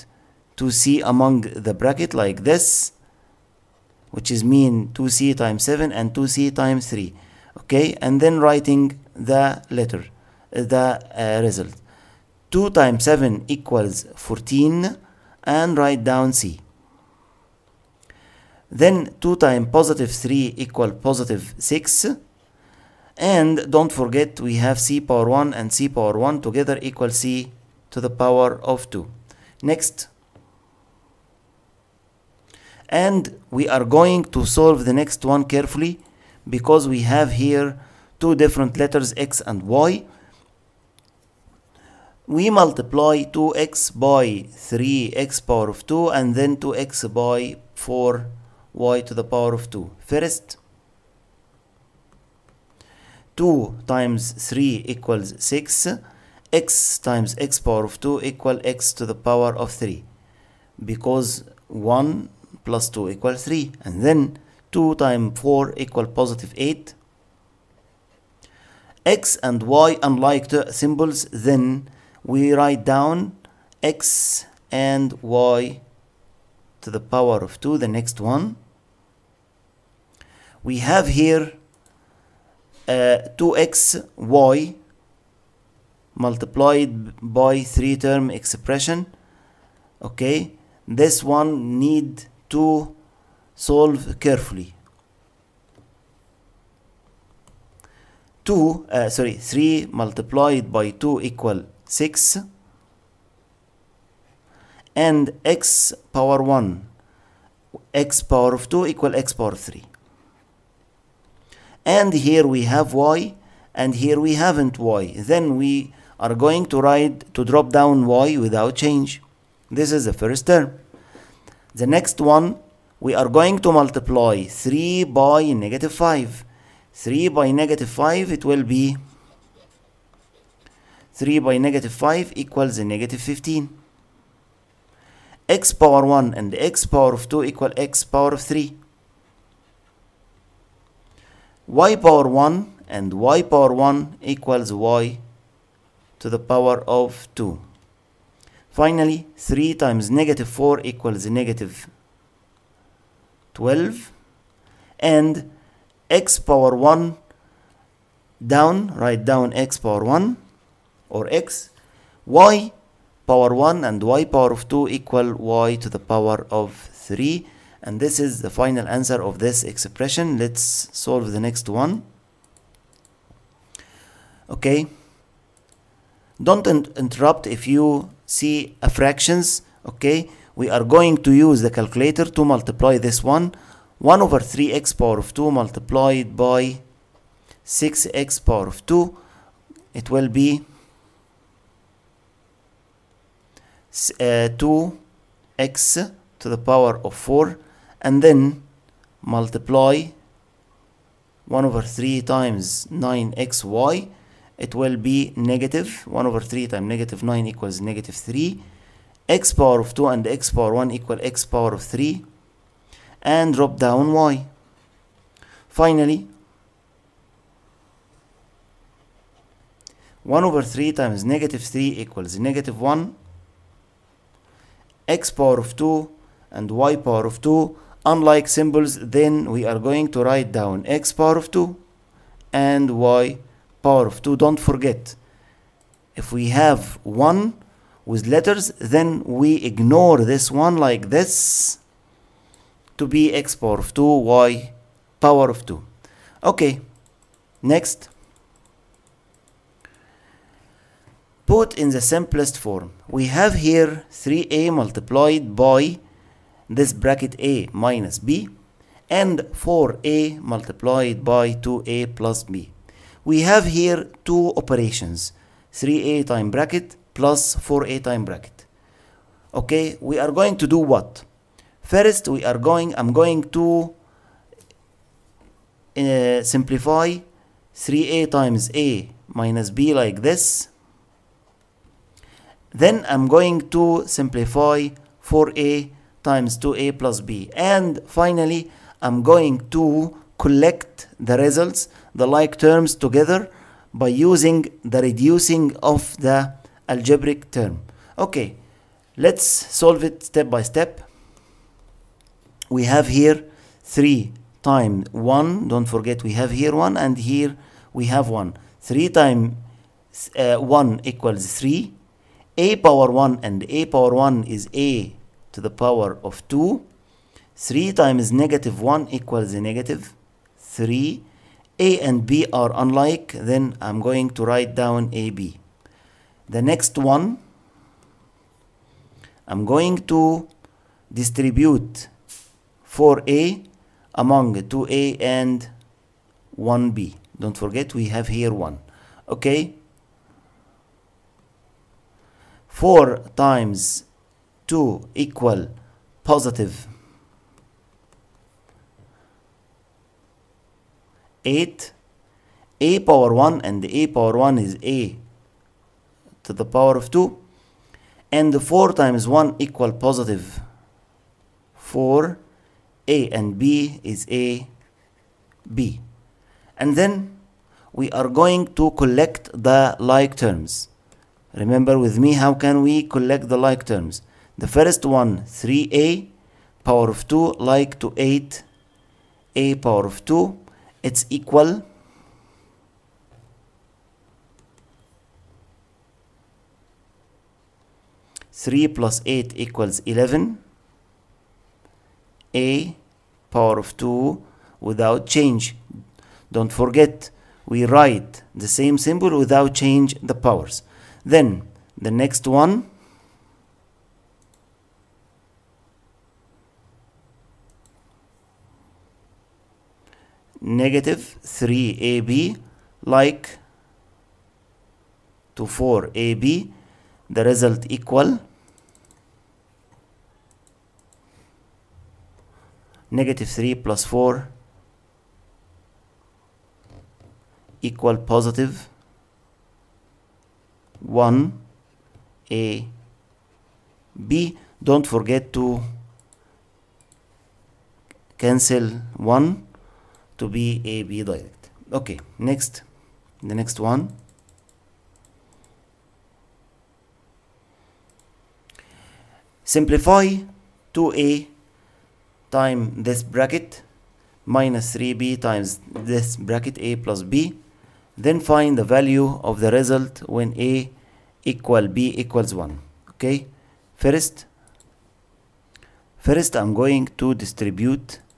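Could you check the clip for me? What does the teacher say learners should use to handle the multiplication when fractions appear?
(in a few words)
the calculator.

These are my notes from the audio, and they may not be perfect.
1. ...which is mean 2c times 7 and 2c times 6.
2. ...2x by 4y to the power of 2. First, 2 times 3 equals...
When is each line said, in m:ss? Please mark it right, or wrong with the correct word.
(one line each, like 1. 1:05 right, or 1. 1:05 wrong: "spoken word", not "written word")
1. 0:04 wrong: "3", not "6"
2. 0:46 right.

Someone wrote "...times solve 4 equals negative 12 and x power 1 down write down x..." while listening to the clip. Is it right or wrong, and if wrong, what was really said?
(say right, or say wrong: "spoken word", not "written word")
wrong: "negative", not "solve".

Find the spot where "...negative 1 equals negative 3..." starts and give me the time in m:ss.
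5:18.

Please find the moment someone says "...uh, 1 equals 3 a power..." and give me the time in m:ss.
5:10.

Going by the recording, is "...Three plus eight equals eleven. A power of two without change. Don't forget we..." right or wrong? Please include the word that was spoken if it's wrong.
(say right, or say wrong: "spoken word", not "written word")
right.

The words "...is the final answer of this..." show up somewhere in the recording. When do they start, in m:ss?
2:48.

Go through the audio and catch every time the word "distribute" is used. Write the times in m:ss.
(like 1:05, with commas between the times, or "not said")
5:31, 7:47.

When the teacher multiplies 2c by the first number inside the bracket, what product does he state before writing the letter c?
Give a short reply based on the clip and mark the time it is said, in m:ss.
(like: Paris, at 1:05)
14, at 0:12.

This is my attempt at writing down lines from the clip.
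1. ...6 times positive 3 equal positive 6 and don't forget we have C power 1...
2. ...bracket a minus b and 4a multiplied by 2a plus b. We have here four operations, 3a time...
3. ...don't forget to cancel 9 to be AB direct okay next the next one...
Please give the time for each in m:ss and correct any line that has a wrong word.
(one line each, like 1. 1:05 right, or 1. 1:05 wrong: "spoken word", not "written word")
1. 0:19 wrong: "2", not "6"
2. 4:16 wrong: "two", not "four"
3. 7:14 wrong: "1", not "9".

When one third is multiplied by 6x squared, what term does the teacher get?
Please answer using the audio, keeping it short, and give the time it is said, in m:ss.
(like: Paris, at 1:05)
2x to the power of 4, at 3:13.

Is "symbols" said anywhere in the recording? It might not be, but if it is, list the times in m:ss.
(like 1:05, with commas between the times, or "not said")
1:10, 3:48, 6:38.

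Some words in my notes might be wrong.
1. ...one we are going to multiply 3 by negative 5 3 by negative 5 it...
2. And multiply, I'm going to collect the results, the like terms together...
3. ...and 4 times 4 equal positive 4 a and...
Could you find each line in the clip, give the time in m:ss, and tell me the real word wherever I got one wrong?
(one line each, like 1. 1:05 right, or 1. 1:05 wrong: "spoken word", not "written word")
1. 2:02 right
2. 4:47 wrong: "finally", not "multiply"
3. 5:58 wrong: "1", not "4".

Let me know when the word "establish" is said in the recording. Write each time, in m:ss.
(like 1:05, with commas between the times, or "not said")
not said.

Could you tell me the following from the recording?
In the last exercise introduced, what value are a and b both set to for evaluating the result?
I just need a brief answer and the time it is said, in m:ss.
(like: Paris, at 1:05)
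1, at 7:42.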